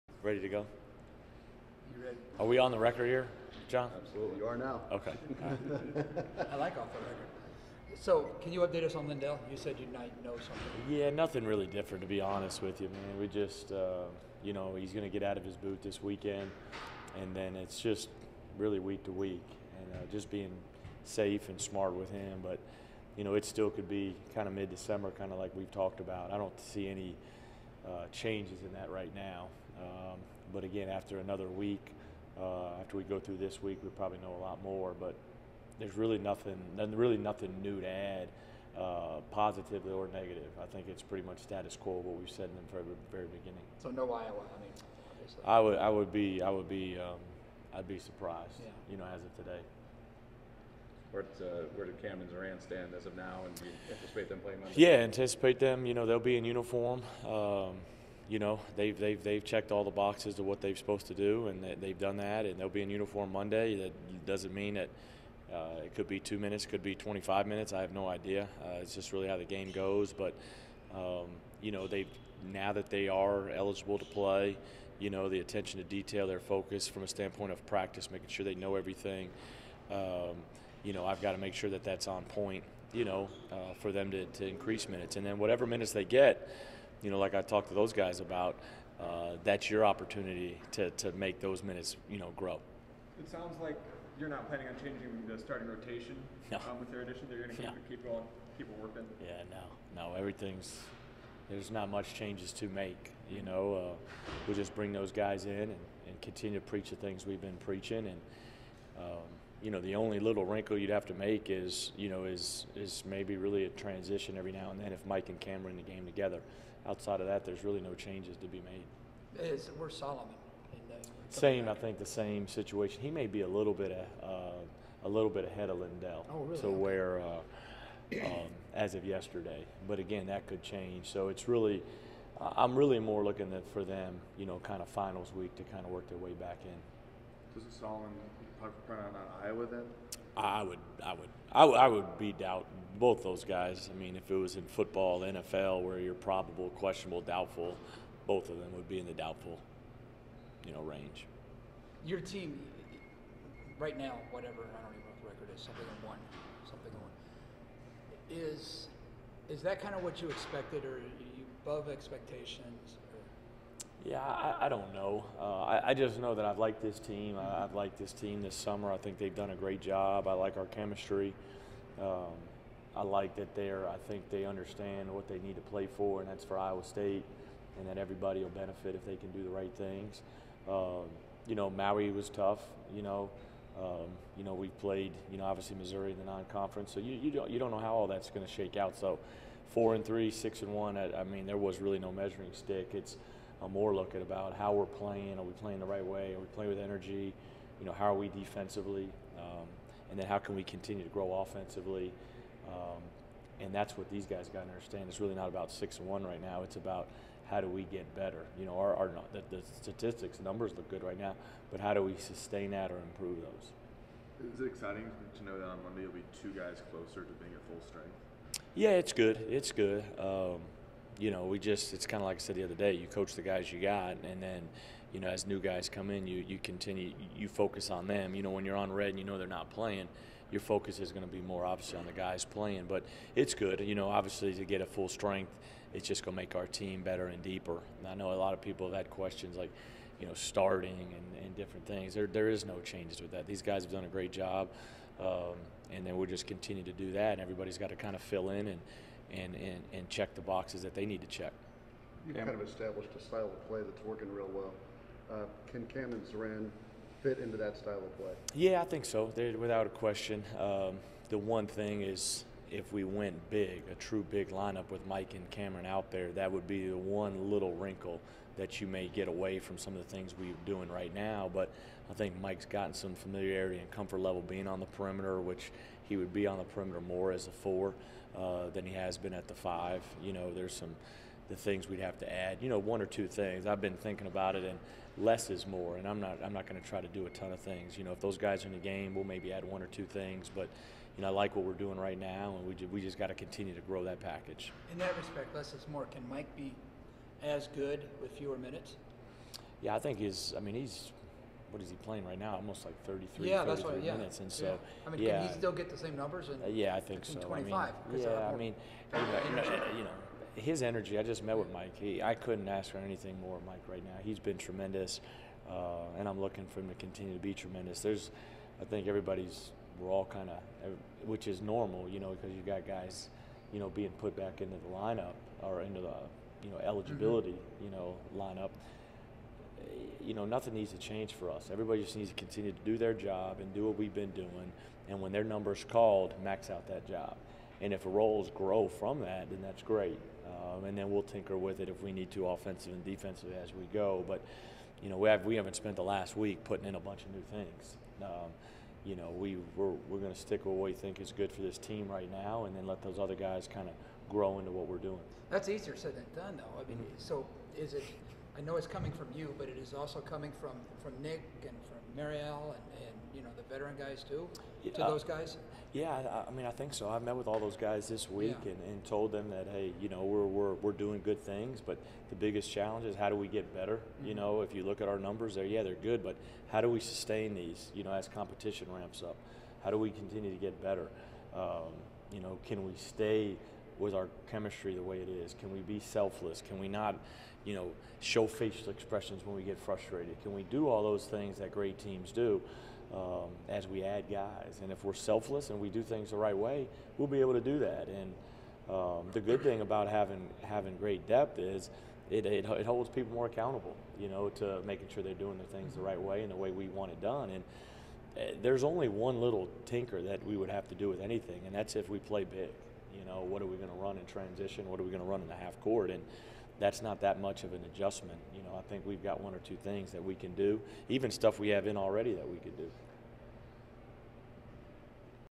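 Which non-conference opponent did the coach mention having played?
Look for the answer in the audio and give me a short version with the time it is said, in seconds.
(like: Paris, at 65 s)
Missouri, at 185 s.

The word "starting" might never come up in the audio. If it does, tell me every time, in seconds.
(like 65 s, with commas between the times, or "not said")
95 s, 240 s.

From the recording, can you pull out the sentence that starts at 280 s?
You know, there's some the things we'd have to add.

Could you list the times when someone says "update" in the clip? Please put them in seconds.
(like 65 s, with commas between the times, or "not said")
8 s.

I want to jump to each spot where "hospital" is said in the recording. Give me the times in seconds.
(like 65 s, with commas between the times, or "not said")
not said.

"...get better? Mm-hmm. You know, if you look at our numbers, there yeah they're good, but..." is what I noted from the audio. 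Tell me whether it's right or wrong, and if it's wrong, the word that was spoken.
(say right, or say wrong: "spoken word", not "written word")
right.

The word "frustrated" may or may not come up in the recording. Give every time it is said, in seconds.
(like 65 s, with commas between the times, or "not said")
389 s.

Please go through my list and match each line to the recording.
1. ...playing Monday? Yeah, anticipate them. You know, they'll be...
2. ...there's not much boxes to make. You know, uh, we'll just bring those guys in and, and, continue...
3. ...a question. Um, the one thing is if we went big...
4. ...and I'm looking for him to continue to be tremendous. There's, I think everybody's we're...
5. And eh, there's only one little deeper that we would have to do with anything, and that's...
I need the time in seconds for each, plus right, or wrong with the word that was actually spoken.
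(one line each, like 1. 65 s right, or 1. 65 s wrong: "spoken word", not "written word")
1. 54 s right
2. 101 s wrong: "changes", not "boxes"
3. 259 s right
4. 316 s right
5. 407 s wrong: "tinker", not "deeper".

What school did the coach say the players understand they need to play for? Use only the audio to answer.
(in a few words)
Iowa State.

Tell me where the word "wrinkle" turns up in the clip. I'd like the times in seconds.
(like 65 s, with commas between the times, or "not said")
110 s, 267 s.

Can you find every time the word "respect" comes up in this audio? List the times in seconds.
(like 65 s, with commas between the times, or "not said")
295 s.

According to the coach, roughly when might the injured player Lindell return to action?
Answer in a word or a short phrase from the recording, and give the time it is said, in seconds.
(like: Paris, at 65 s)
mid-December, at 24 s.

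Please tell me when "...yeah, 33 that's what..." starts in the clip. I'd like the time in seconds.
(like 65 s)
303 s.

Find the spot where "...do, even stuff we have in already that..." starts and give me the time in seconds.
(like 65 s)
420 s.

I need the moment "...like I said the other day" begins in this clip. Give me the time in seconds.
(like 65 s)
222 s.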